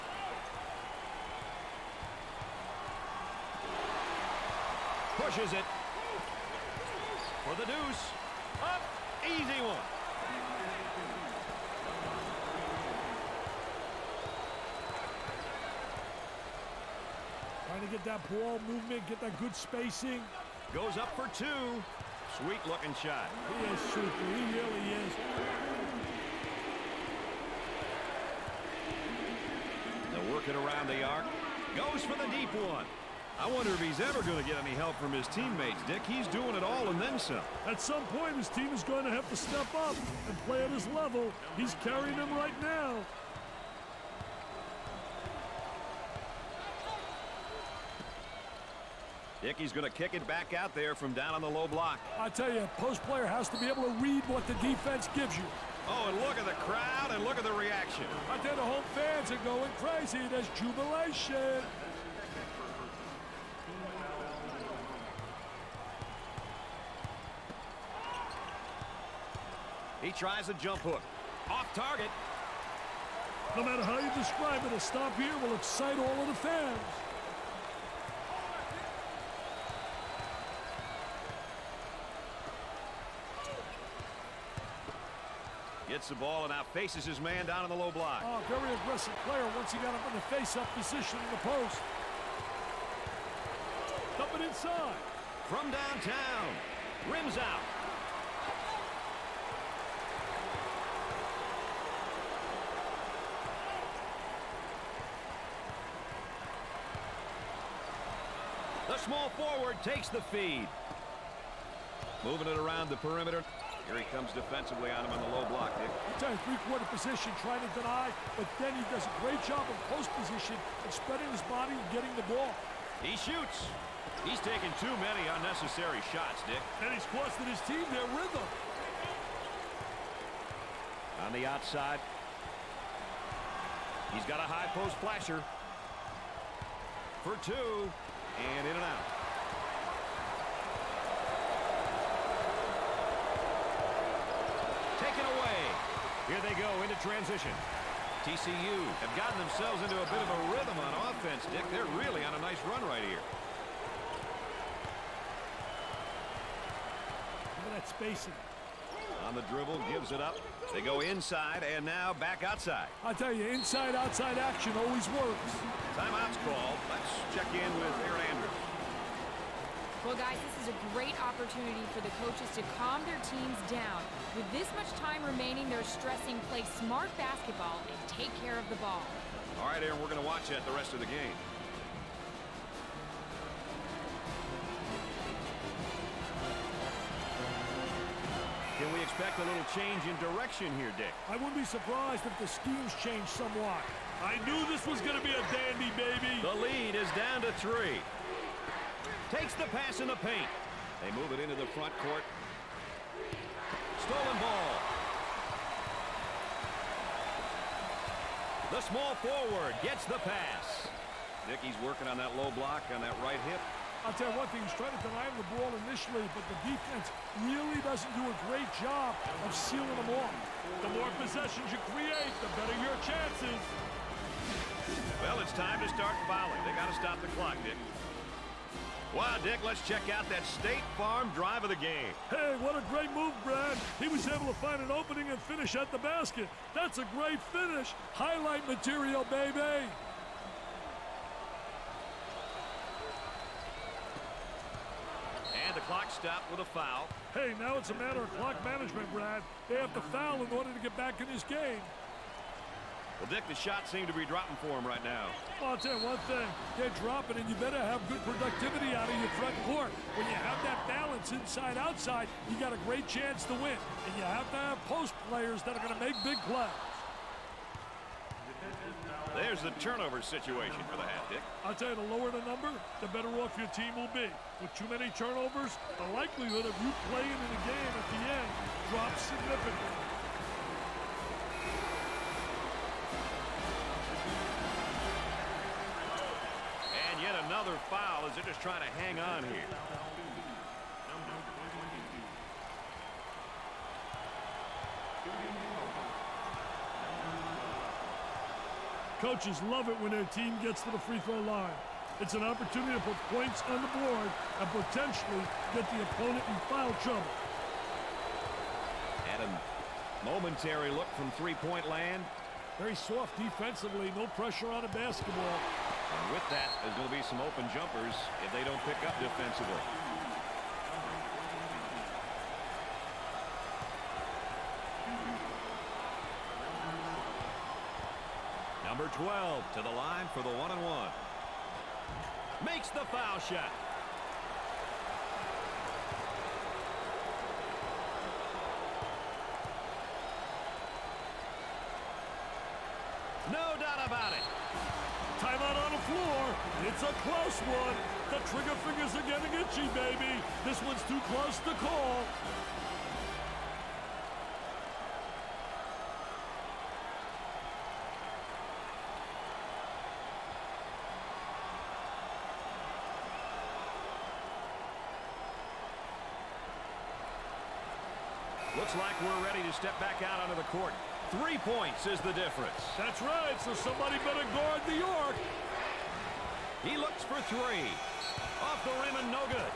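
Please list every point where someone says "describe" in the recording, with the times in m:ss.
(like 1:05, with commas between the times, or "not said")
1:14.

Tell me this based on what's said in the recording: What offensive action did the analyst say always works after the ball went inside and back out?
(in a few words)
inside-outside action.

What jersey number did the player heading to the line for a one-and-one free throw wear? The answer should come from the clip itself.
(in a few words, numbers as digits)
12.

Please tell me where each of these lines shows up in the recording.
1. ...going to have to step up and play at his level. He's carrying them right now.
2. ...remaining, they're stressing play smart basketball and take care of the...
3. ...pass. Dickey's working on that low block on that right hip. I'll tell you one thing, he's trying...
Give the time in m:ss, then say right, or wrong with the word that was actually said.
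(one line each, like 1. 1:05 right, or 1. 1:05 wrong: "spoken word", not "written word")
1. 0:38 right
2. 2:55 right
3. 3:30 right.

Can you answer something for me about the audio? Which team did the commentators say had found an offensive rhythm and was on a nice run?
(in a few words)
TCU.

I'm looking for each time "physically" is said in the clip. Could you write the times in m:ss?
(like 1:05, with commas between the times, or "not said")
not said.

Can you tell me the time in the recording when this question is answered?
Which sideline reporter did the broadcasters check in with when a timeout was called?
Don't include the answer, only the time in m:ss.
2:48.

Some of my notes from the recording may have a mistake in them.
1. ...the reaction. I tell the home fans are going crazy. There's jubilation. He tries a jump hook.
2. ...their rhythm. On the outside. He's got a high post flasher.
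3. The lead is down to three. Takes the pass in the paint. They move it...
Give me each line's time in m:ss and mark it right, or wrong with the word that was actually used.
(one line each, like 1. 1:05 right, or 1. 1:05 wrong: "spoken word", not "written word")
1. 0:57 right
2. 2:07 right
3. 3:16 right.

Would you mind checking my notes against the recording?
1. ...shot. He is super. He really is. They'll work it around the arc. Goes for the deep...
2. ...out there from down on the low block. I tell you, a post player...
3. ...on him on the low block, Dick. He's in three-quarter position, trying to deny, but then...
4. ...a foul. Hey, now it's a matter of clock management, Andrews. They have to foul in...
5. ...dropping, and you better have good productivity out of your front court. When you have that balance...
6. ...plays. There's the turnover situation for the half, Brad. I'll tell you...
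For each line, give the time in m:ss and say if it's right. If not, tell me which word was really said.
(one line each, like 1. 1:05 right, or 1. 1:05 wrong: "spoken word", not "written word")
1. 0:22 right
2. 0:50 right
3. 1:54 right
4. 4:06 wrong: "Brad", not "Andrews"
5. 4:16 right
6. 4:26 wrong: "Dick", not "Brad".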